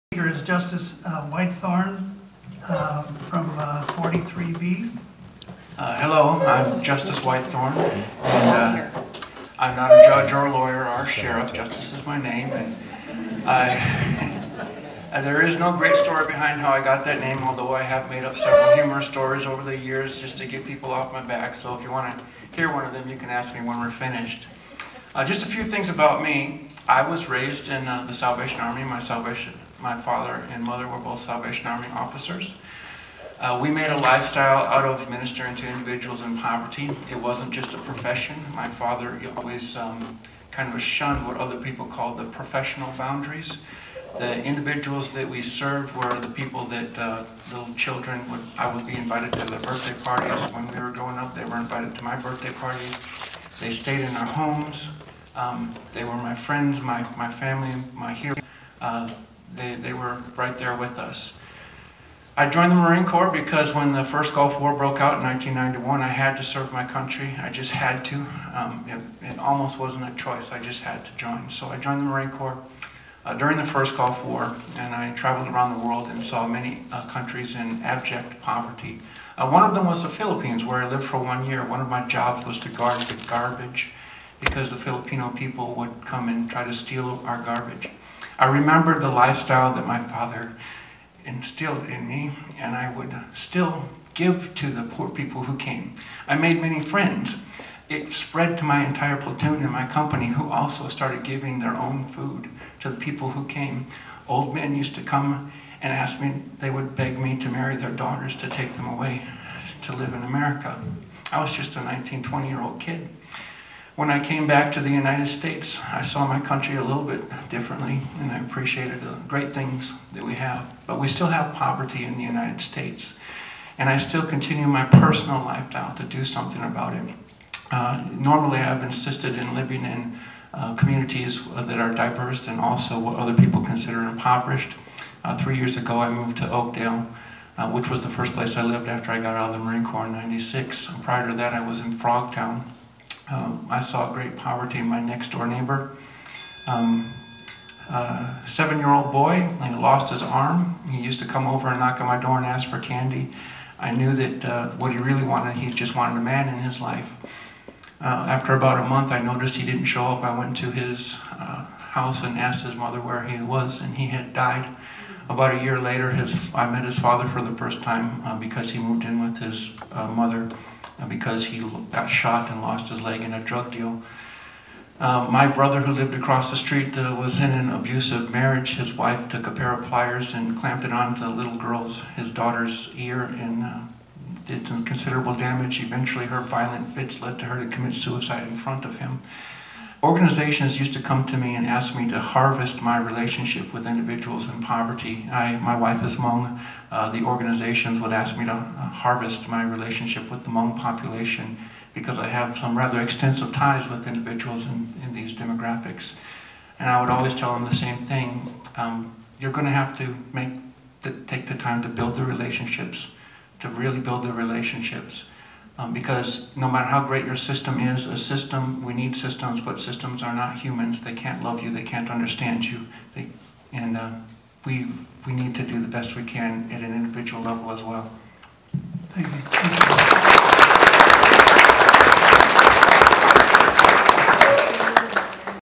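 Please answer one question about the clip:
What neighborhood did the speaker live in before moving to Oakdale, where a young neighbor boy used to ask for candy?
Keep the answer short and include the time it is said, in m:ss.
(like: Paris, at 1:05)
Frogtown, at 2:21.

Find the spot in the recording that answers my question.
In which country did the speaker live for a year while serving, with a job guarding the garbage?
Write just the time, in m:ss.
1:20.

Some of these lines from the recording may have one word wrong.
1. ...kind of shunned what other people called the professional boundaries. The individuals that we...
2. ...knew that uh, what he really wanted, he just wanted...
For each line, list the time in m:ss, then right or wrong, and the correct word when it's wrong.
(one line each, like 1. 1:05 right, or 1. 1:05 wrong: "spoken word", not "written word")
1. 0:40 right
2. 2:33 right.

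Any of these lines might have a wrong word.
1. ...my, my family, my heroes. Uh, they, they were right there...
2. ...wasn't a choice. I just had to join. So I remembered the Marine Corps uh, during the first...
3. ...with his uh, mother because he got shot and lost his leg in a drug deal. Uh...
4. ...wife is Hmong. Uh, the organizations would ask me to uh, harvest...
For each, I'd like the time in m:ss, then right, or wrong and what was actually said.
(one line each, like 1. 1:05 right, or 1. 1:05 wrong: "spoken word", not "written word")
1. 0:56 right
2. 1:09 wrong: "joined", not "remembered"
3. 2:49 right
4. 3:15 right.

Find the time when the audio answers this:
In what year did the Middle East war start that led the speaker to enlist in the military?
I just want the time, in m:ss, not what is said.
1:05.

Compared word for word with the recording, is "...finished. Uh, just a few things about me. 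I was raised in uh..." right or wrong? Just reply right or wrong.
right.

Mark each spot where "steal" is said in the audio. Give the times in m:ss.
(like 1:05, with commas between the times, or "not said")
1:26.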